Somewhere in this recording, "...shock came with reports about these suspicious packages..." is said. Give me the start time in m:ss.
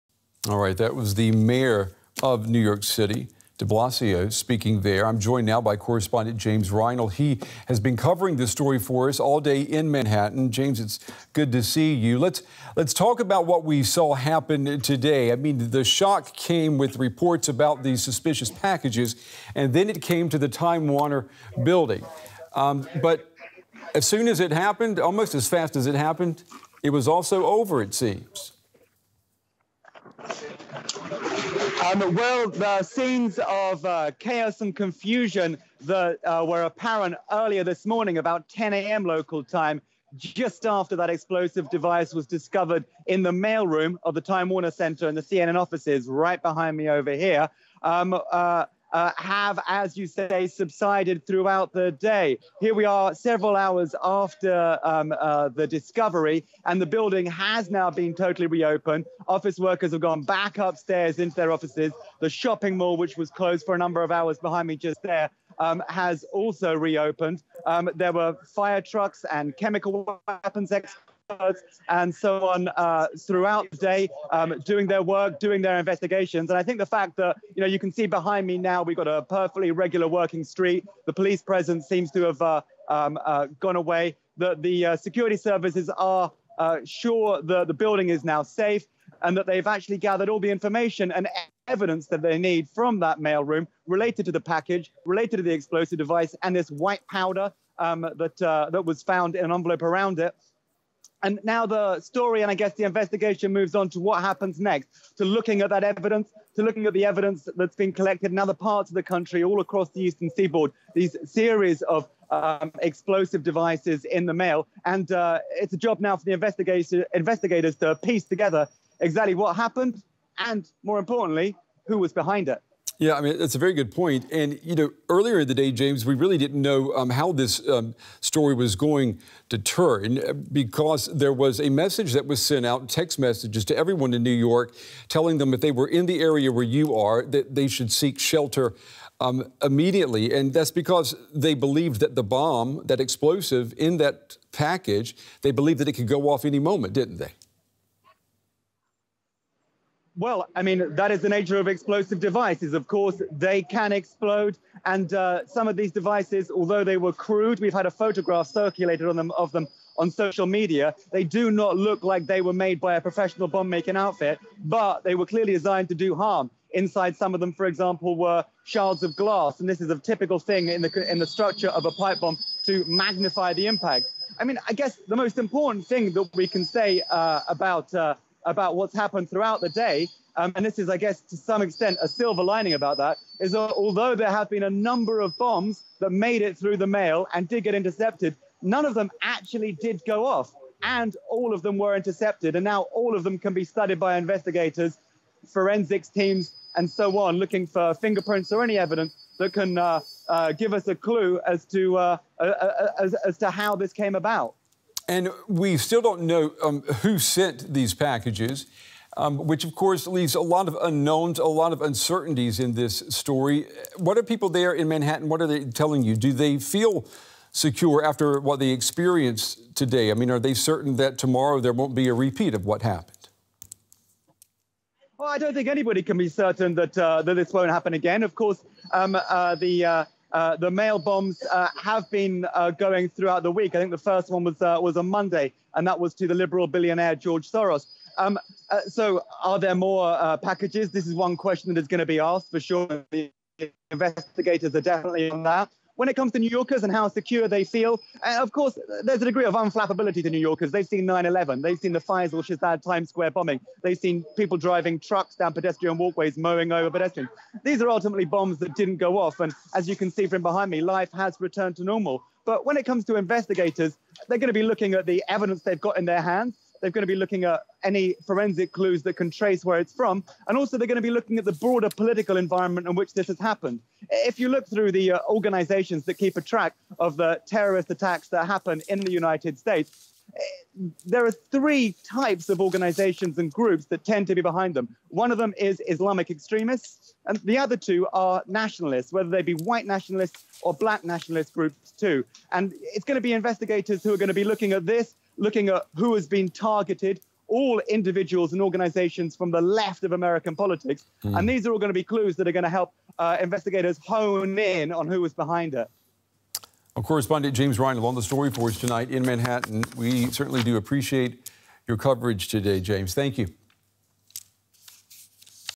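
0:15.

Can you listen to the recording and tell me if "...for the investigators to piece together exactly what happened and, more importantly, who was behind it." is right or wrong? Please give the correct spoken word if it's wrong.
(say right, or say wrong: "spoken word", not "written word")
right.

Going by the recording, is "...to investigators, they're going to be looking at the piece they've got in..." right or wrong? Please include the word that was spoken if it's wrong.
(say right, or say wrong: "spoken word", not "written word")
wrong: "evidence", not "piece".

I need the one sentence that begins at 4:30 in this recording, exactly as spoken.
And also, they're going to be looking at the broader political environment in which this has happened.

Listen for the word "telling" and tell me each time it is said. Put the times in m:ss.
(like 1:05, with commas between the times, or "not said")
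2:15, 3:35.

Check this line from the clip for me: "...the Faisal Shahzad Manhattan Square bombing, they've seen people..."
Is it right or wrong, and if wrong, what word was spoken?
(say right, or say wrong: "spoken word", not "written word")
wrong: "Times", not "Manhattan".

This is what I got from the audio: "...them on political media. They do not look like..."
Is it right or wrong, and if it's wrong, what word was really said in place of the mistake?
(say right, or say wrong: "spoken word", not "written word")
wrong: "social", not "political".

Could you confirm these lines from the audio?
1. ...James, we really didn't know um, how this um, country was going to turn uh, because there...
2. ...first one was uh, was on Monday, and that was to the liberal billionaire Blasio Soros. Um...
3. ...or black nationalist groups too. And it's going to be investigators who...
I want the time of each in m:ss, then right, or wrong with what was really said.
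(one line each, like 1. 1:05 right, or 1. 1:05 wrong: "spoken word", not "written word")
1. 2:05 wrong: "story", not "country"
2. 3:53 wrong: "George", not "Blasio"
3. 4:50 right.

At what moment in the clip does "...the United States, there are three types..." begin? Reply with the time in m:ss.
4:38.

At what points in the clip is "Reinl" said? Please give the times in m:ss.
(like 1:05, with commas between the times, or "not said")
0:06, 5:07.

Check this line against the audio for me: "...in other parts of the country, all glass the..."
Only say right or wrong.
wrong.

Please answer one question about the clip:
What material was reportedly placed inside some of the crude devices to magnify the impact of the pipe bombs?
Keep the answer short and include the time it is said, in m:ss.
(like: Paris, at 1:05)
Shards of glass, at 2:48.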